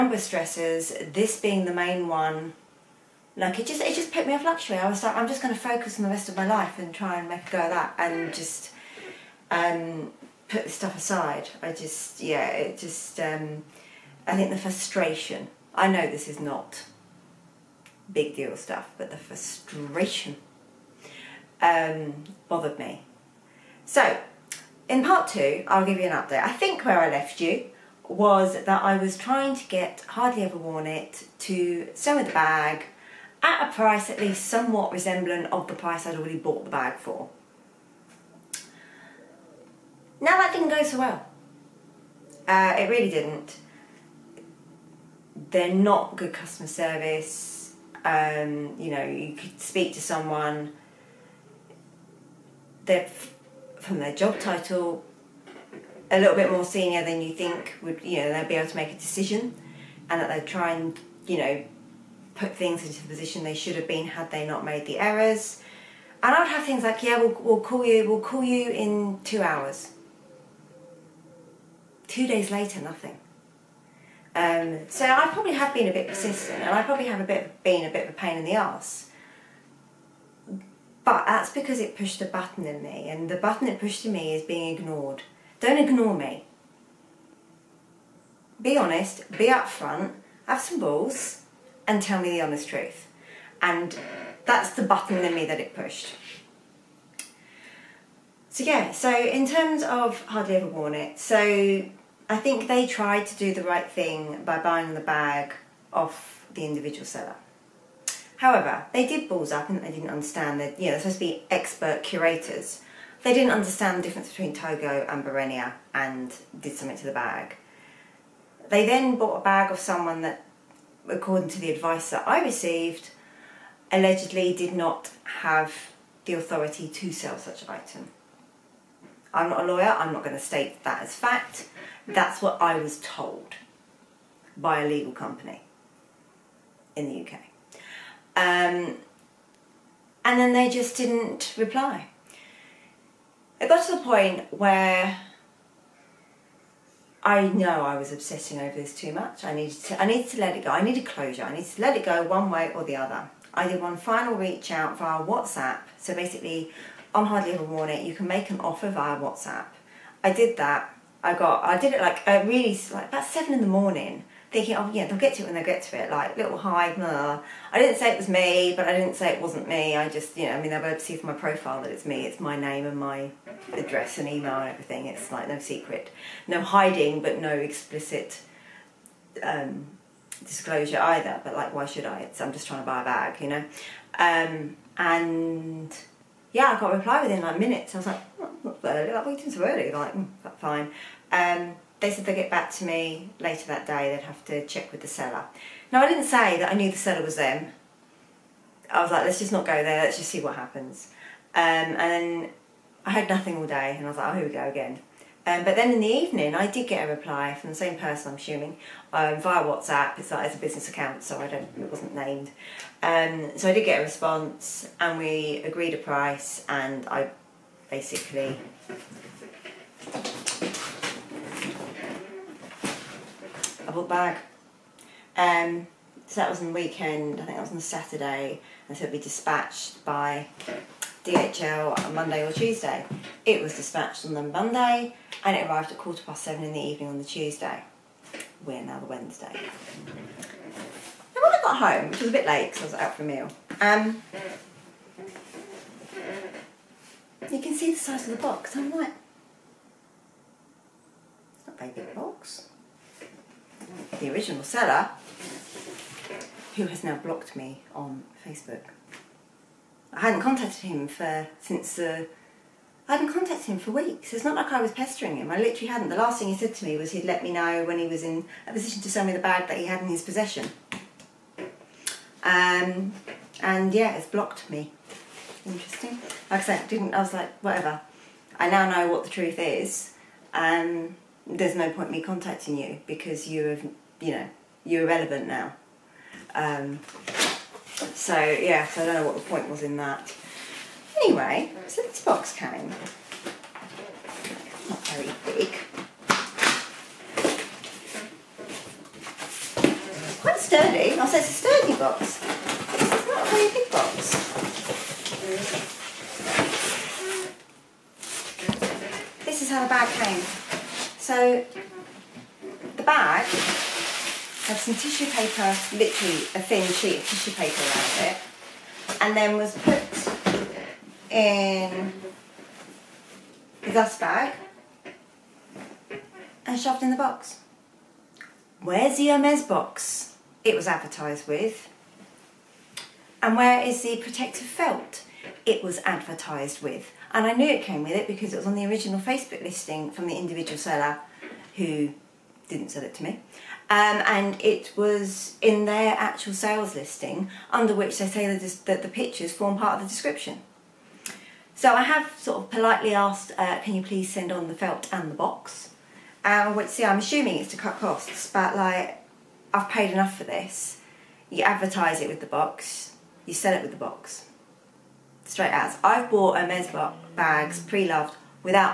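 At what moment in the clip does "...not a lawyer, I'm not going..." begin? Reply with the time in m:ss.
2:09.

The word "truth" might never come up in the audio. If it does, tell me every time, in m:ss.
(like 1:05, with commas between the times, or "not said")
1:32, 4:39.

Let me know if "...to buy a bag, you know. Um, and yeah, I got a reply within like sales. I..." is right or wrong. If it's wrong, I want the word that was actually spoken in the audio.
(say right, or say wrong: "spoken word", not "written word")
wrong: "minutes", not "sales".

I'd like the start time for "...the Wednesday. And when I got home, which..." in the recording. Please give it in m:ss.
3:58.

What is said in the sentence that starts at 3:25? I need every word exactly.
Um, but then in the evening, I did get a reply from the same person, I'm assuming, um, via WhatsApp.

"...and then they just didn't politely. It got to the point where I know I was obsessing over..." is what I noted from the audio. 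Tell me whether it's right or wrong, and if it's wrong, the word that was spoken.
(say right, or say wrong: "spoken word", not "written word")
wrong: "reply", not "politely".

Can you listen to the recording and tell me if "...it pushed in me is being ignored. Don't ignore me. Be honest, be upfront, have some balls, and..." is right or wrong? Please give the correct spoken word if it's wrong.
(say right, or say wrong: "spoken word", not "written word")
right.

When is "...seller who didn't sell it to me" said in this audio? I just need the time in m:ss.
5:40.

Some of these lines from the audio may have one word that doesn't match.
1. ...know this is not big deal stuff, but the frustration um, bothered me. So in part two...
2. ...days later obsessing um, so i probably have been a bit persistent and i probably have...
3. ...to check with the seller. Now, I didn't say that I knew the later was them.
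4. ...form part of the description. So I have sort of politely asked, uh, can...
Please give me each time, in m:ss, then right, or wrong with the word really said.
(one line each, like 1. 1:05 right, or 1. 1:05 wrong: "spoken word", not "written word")
1. 0:15 right
2. 1:12 wrong: "nothing", not "obsessing"
3. 3:14 wrong: "seller", not "later"
4. 5:49 right.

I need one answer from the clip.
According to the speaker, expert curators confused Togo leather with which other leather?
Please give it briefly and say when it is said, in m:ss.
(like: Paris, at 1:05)
Barenia, at 1:55.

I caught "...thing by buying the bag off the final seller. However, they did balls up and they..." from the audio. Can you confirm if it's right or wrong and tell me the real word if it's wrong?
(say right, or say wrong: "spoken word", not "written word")
wrong: "individual", not "final".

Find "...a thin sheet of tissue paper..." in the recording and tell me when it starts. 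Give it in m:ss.
5:16.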